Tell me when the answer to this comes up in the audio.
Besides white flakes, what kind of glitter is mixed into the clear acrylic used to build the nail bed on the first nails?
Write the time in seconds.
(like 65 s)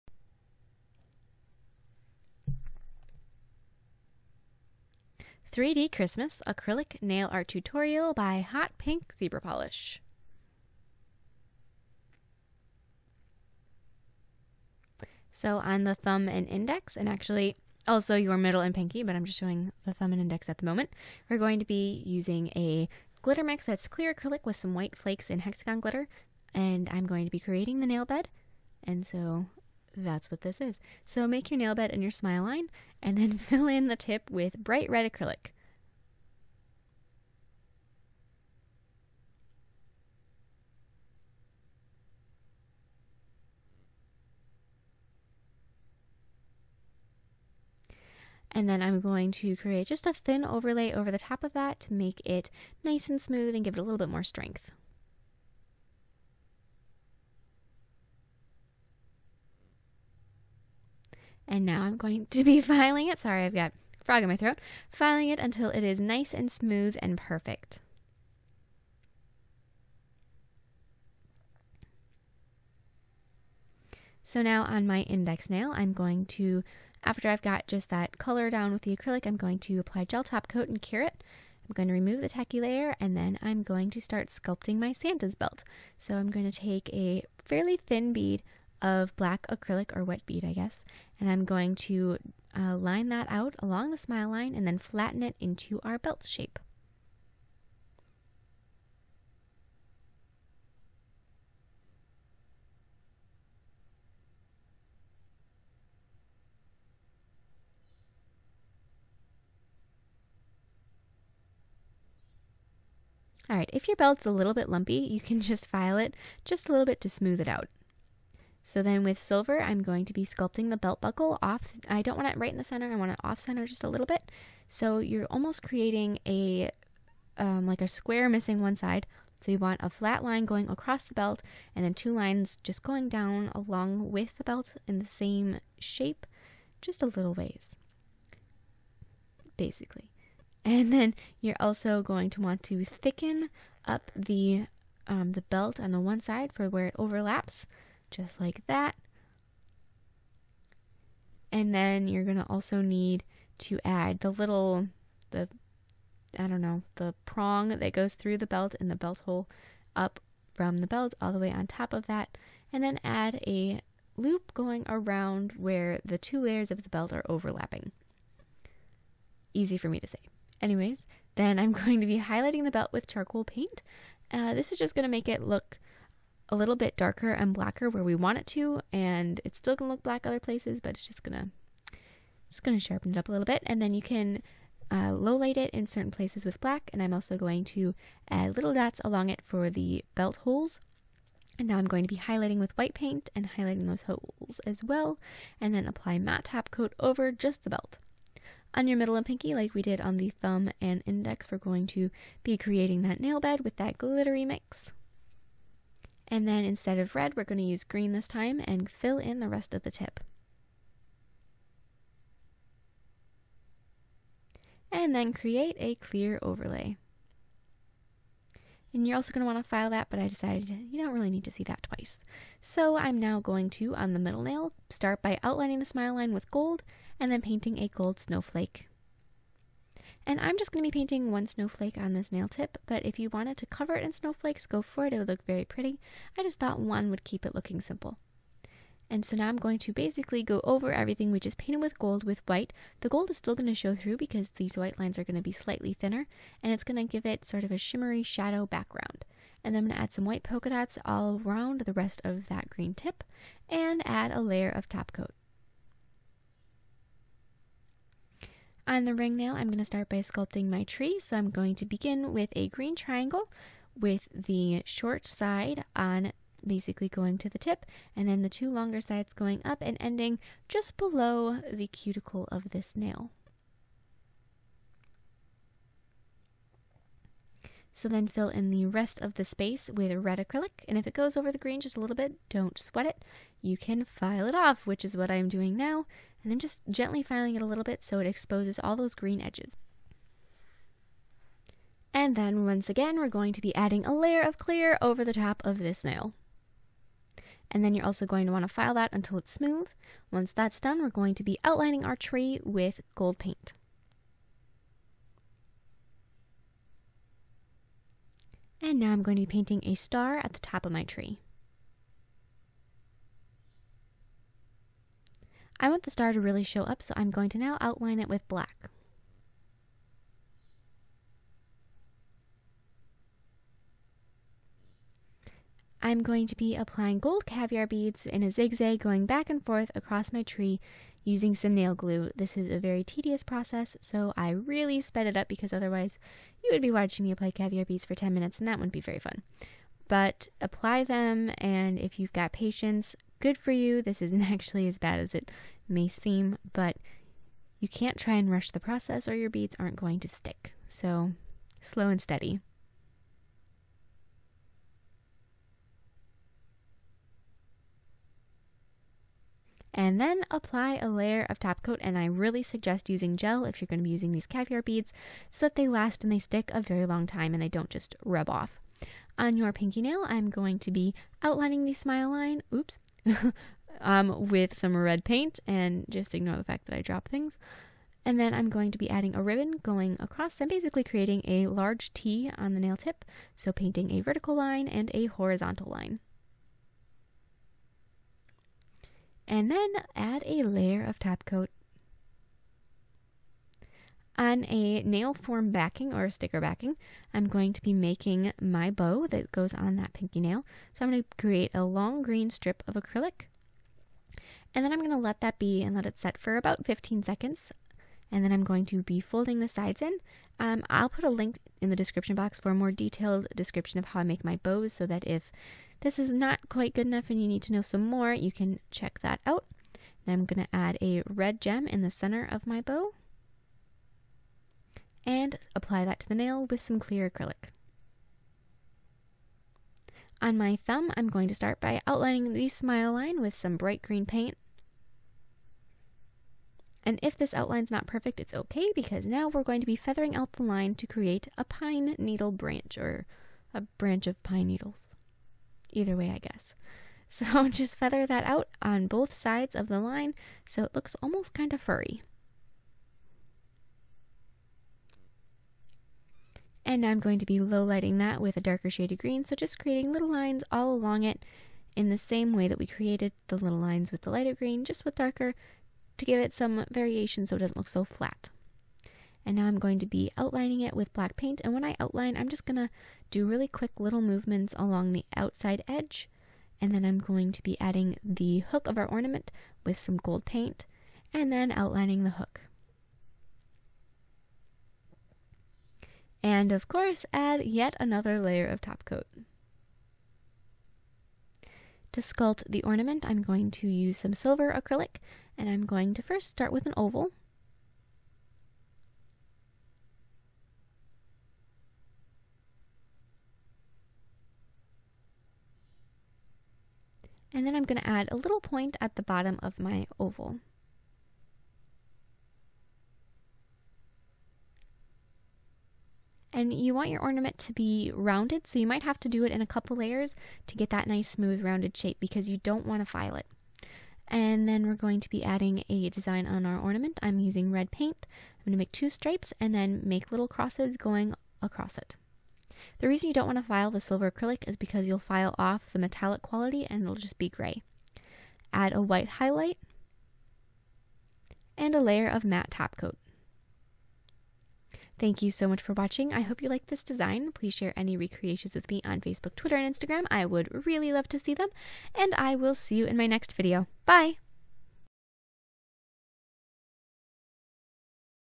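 25 s.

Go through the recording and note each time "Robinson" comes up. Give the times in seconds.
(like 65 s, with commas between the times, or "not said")
not said.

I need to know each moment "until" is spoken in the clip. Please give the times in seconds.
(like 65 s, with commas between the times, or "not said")
65 s, 299 s.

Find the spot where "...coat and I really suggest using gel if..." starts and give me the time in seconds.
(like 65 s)
361 s.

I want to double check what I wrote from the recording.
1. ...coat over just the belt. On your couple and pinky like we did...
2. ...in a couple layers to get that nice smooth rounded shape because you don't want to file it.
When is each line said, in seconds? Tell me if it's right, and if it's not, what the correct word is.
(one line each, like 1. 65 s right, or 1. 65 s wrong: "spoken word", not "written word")
1. 196 s wrong: "middle", not "couple"
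2. 519 s right.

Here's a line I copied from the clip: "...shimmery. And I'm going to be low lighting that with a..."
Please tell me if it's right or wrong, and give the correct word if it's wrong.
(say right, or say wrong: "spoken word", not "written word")
wrong: "furry", not "shimmery".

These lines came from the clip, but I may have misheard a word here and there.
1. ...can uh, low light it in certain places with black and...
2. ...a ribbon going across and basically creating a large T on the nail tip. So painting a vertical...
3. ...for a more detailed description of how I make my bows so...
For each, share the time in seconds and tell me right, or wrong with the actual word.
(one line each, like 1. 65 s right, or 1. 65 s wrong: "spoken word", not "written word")
1. 184 s right
2. 379 s right
3. 412 s right.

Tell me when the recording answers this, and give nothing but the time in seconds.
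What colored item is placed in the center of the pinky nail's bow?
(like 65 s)
421 s.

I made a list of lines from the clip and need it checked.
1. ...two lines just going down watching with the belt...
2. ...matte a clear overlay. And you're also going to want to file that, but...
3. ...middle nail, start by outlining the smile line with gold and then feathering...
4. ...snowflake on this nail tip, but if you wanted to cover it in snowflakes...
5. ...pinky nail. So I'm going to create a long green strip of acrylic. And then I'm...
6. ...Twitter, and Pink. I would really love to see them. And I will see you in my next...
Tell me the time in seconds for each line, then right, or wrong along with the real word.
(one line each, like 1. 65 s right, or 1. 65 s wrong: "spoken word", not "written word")
1. 131 s wrong: "along", not "watching"
2. 215 s wrong: "create", not "matte"
3. 224 s wrong: "painting", not "feathering"
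4. 231 s right
5. 400 s right
6. 549 s wrong: "Instagram", not "Pink".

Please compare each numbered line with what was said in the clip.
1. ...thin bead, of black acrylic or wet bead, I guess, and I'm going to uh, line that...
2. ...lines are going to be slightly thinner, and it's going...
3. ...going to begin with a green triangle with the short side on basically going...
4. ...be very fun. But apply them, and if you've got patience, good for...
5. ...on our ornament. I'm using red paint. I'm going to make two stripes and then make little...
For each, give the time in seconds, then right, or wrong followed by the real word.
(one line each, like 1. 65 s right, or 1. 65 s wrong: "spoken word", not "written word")
1. 87 s right
2. 244 s right
3. 261 s right
4. 338 s right
5. 526 s right.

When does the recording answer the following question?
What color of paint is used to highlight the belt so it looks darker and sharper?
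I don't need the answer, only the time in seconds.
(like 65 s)
173 s.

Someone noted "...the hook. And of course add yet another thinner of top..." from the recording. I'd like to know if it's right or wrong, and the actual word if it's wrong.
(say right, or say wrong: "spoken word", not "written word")
wrong: "layer", not "thinner".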